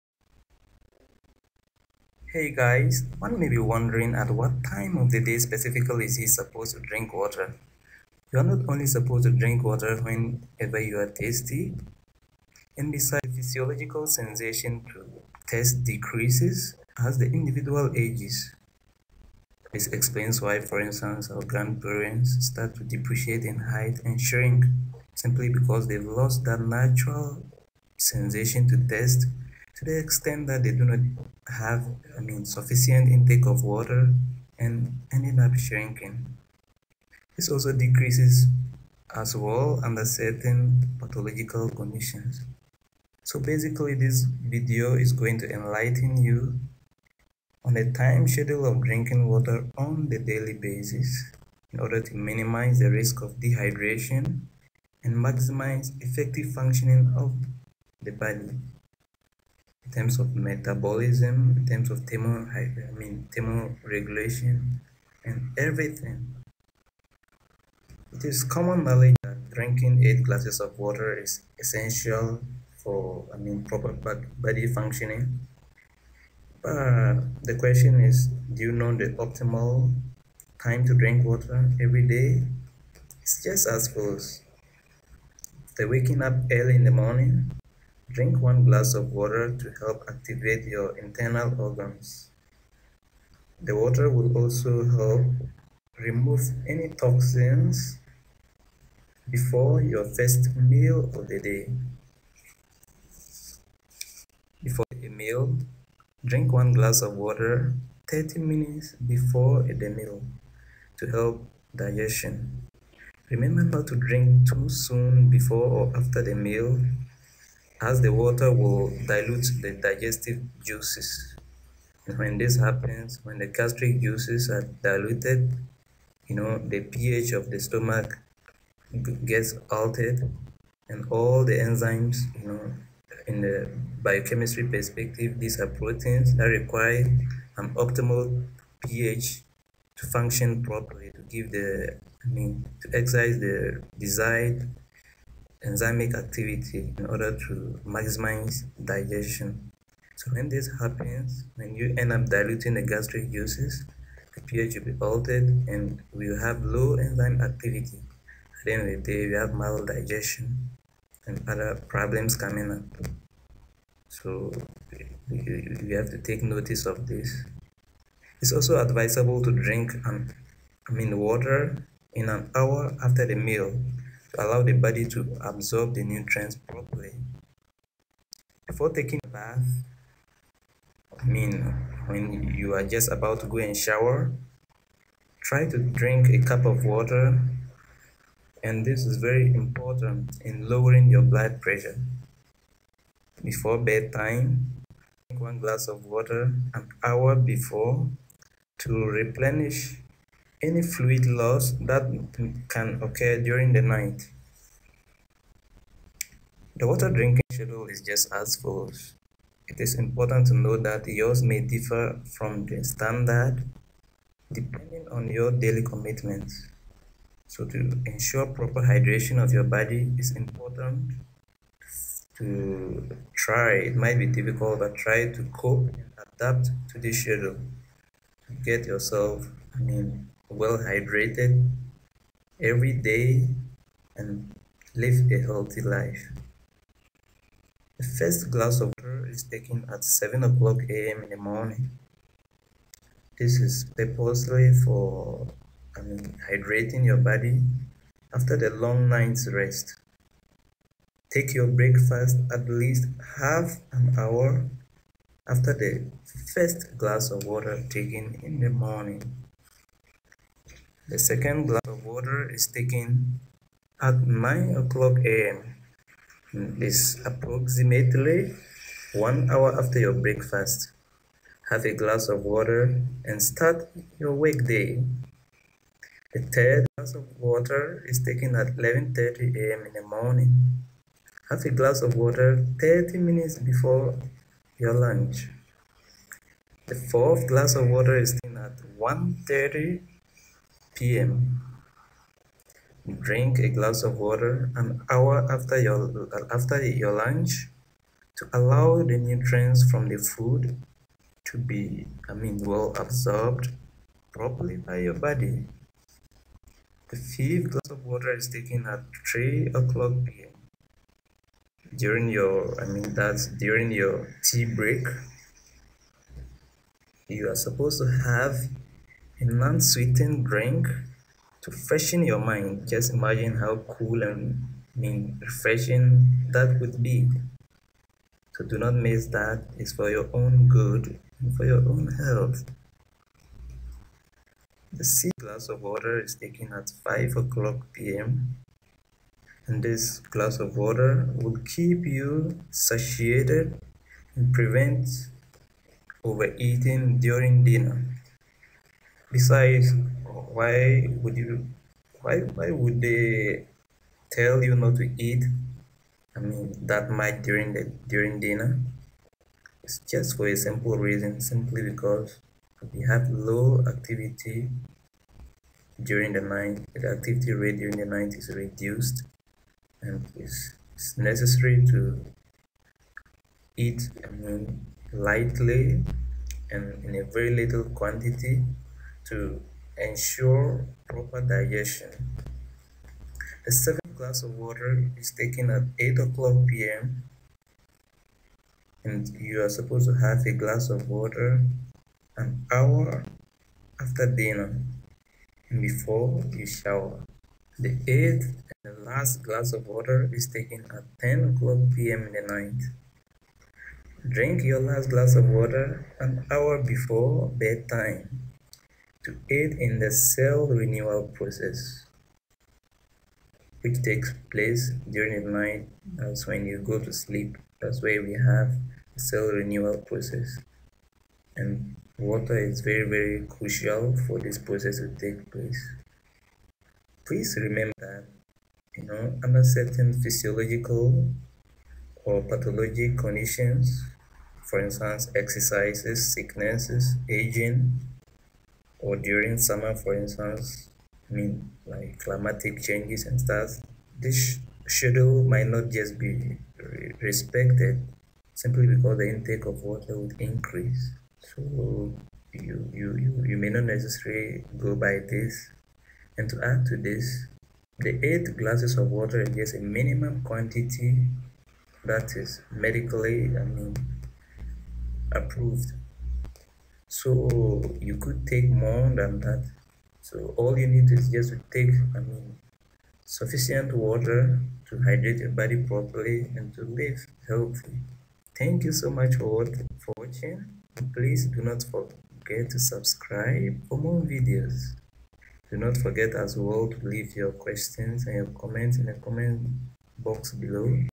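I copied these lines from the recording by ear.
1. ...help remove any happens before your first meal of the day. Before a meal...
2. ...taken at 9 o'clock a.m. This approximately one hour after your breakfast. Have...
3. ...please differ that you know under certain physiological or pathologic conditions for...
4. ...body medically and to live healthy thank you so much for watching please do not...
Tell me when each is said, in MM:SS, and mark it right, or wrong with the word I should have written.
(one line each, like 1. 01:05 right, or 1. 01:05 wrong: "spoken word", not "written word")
1. 01:34 wrong: "toxins", not "happens"
2. 04:22 right
3. 07:07 wrong: "remember", not "differ"
4. 07:55 wrong: "properly", not "medically".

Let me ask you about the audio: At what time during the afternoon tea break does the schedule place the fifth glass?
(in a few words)
3 p.m.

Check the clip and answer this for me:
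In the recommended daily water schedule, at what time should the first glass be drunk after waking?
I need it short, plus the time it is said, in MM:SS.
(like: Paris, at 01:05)
7 a.m., at 04:00.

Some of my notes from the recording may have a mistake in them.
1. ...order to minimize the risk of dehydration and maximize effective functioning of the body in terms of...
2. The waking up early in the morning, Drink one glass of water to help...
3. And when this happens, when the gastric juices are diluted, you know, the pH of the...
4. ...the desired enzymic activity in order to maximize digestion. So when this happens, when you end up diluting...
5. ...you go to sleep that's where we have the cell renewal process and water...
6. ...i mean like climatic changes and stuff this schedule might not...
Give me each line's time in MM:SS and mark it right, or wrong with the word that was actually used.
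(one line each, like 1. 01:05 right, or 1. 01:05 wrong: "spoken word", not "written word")
1. 00:51 right
2. 01:25 right
3. 02:02 right
4. 02:23 right
5. 06:56 right
6. 07:21 right.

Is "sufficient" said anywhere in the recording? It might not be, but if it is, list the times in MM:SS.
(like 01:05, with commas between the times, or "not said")
00:32, 07:53.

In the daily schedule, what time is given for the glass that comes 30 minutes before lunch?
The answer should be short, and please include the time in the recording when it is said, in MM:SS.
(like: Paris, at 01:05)
11:30 a.m., at 04:38.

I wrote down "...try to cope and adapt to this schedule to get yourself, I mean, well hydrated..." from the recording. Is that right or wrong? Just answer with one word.
right.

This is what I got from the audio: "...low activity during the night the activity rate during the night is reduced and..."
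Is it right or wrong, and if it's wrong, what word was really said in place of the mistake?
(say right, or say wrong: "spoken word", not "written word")
right.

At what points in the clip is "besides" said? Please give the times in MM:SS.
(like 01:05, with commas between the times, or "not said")
00:12, 05:49.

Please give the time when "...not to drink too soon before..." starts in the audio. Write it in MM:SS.
01:53.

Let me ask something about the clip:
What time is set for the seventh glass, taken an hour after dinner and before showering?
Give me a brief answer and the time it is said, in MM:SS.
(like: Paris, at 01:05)
8 p.m., at 06:25.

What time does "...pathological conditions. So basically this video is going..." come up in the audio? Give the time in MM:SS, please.
00:40.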